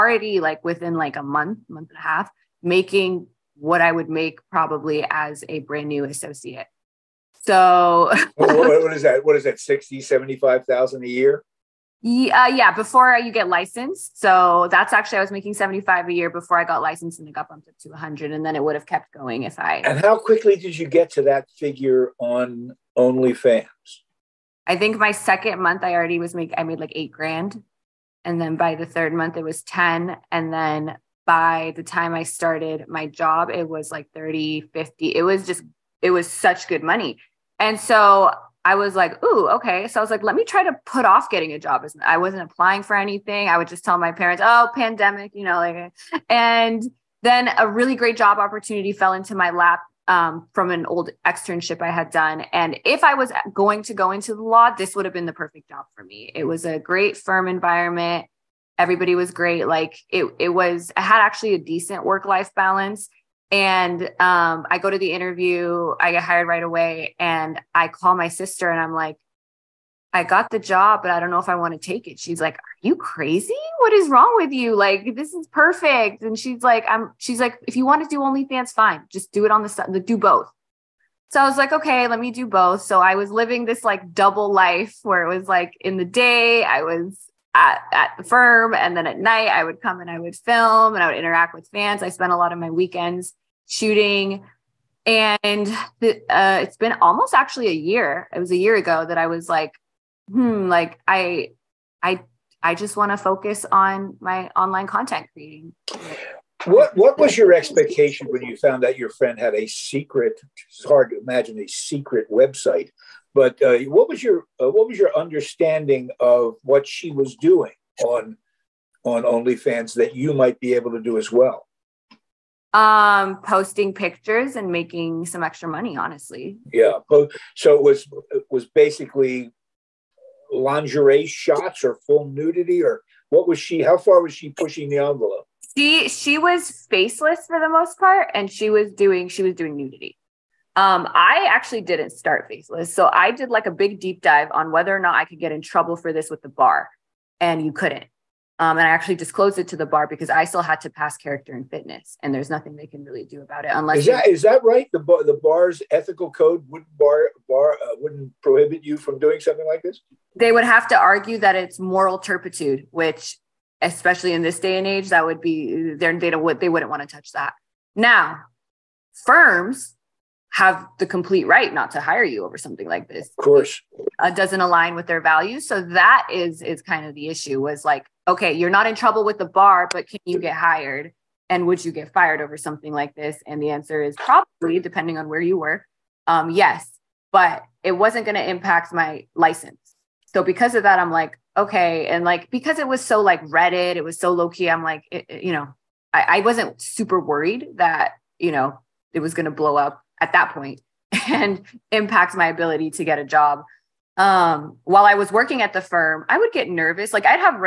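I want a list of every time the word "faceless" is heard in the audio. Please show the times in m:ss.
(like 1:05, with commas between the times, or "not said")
2:16, 2:22.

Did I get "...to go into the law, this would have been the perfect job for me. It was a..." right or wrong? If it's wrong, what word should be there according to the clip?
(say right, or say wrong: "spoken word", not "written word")
right.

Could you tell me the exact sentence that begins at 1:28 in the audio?
And then at night, I would come and I would film and I would interact with fans.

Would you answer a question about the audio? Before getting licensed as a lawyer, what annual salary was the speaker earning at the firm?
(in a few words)
75.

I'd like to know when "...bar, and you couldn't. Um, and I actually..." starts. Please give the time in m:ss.
2:26.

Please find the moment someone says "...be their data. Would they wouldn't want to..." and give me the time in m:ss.
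2:45.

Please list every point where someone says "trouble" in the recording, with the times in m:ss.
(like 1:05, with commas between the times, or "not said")
2:25, 2:58.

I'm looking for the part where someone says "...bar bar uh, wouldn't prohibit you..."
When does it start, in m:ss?
2:36.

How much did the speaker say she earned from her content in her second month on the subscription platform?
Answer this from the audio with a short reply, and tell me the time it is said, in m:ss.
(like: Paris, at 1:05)
8 grand, at 0:26.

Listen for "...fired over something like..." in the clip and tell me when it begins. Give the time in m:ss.
3:02.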